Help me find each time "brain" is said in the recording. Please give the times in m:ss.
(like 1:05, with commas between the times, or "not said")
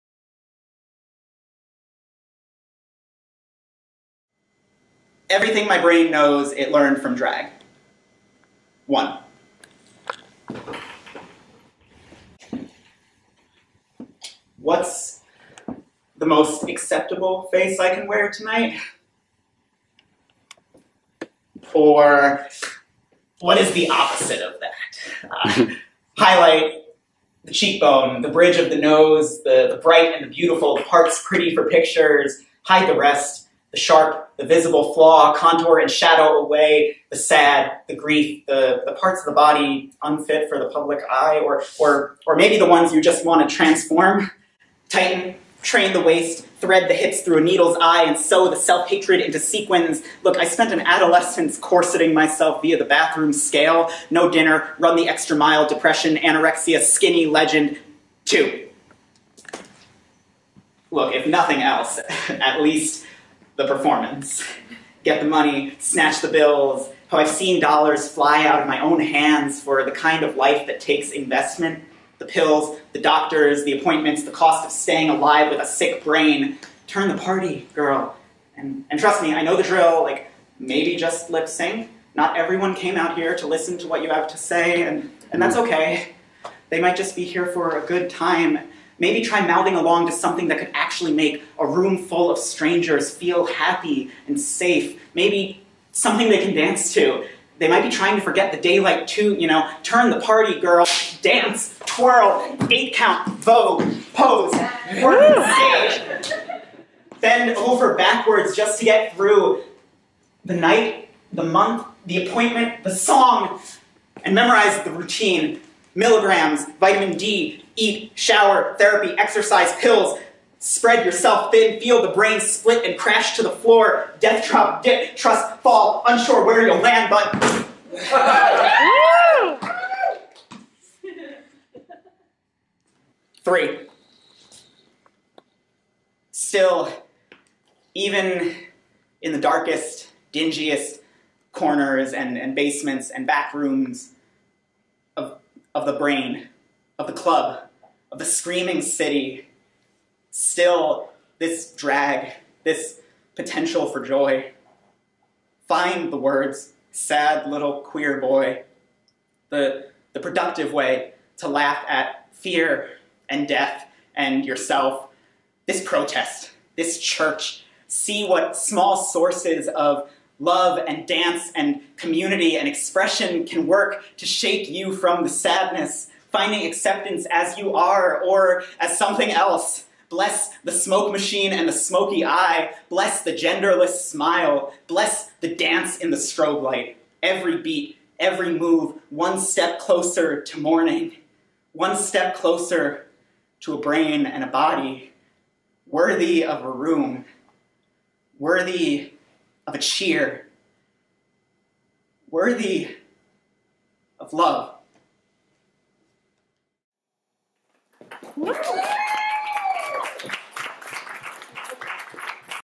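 0:05, 1:16, 2:02, 2:25, 3:13.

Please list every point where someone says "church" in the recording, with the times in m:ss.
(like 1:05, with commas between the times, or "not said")
2:46.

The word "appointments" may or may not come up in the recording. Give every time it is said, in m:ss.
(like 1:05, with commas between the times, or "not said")
1:13, 1:52.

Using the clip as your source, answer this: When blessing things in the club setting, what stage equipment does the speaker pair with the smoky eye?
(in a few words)
smoke machine.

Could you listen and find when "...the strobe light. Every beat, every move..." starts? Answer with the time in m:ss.
3:06.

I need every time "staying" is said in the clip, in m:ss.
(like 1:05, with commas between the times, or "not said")
1:14.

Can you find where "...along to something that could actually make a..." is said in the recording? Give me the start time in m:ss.
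1:29.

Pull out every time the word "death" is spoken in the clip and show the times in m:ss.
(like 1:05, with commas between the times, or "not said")
2:04, 2:43.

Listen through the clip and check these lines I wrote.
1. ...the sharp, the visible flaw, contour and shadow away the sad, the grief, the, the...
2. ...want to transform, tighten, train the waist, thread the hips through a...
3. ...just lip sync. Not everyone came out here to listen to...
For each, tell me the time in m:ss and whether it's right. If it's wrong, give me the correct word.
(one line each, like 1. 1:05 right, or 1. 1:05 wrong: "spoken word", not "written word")
1. 0:33 right
2. 0:43 right
3. 1:20 right.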